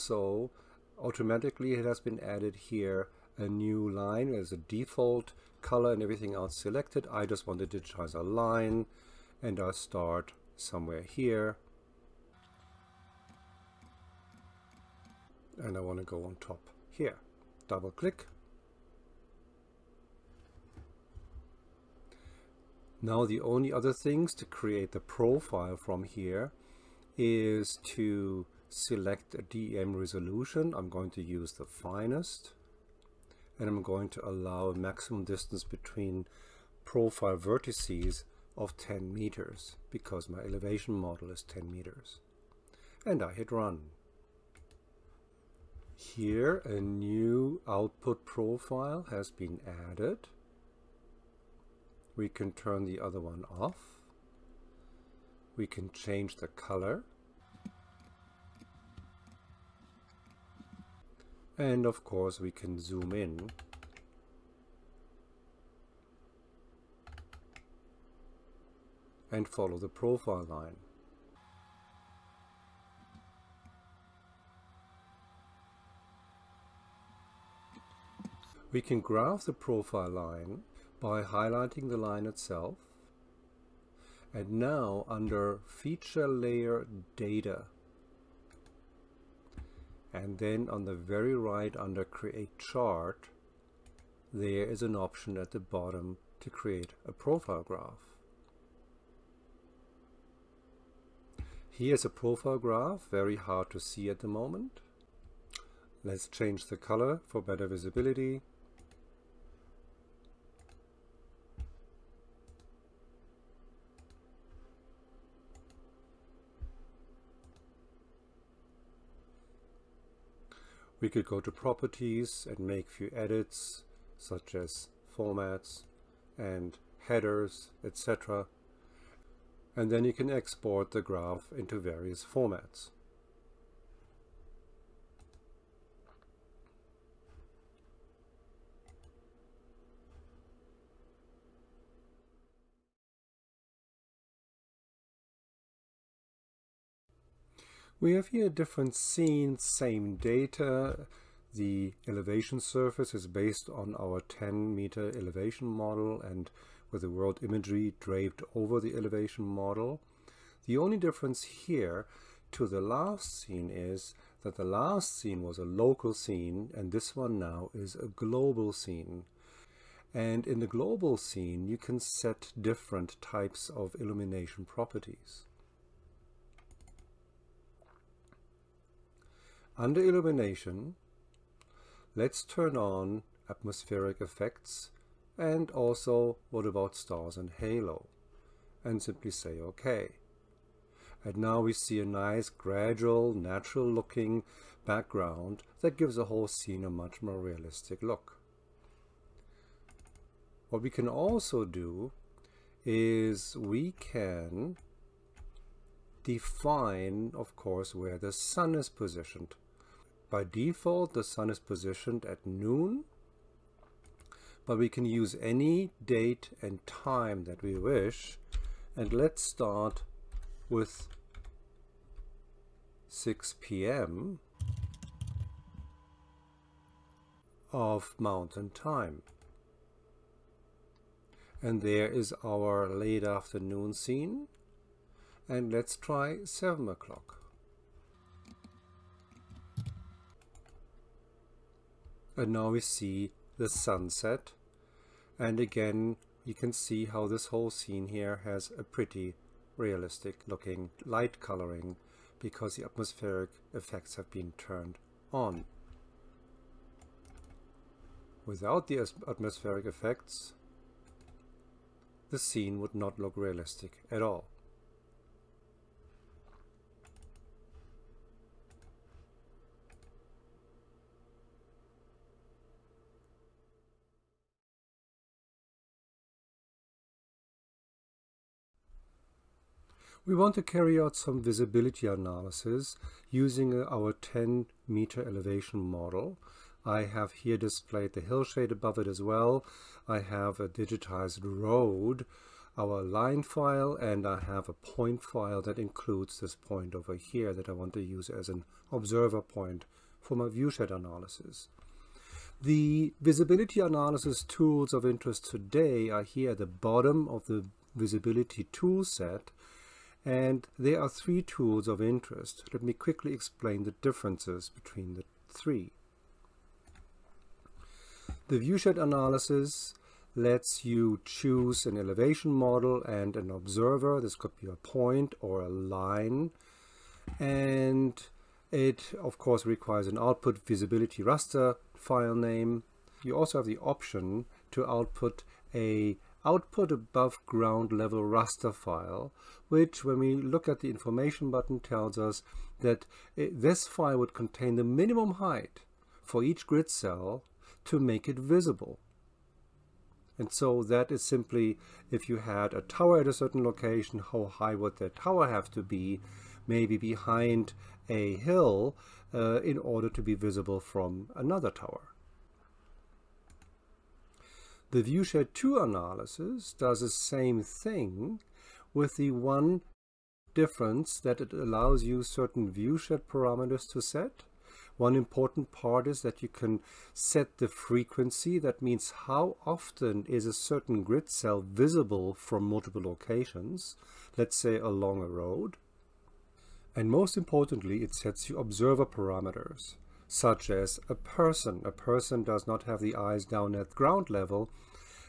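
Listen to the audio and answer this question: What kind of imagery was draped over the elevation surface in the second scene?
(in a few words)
world imagery.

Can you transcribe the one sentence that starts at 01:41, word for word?
Here's a profile graph, very hard to see at the moment.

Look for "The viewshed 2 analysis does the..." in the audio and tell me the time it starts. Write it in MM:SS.
06:04.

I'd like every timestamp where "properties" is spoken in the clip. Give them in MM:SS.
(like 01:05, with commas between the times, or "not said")
02:01, 02:54.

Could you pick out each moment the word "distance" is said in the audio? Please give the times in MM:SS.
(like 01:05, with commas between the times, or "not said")
00:35.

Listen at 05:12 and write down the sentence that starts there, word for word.
Let me quickly explain the differences between the three.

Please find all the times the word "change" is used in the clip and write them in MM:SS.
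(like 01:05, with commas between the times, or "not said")
00:55, 01:46.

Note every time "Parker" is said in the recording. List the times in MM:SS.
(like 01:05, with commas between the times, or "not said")
not said.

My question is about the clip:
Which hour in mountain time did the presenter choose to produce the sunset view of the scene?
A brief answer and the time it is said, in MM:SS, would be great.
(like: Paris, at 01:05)
7 o'clock, at 03:56.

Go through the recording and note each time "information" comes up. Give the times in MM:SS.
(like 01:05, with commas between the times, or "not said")
05:40.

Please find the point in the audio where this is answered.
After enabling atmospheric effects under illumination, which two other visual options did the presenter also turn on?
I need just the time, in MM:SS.
03:06.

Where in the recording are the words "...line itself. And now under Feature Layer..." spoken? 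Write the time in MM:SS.
01:21.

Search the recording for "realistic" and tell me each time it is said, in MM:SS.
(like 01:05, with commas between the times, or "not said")
03:17, 04:09, 04:23.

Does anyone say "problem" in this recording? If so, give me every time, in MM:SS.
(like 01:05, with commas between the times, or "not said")
not said.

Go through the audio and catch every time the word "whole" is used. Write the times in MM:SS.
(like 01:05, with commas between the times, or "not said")
03:16, 04:07.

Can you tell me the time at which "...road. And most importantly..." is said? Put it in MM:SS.
06:25.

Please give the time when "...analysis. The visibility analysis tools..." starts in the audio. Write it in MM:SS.
05:00.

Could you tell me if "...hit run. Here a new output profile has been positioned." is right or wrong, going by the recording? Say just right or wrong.
wrong.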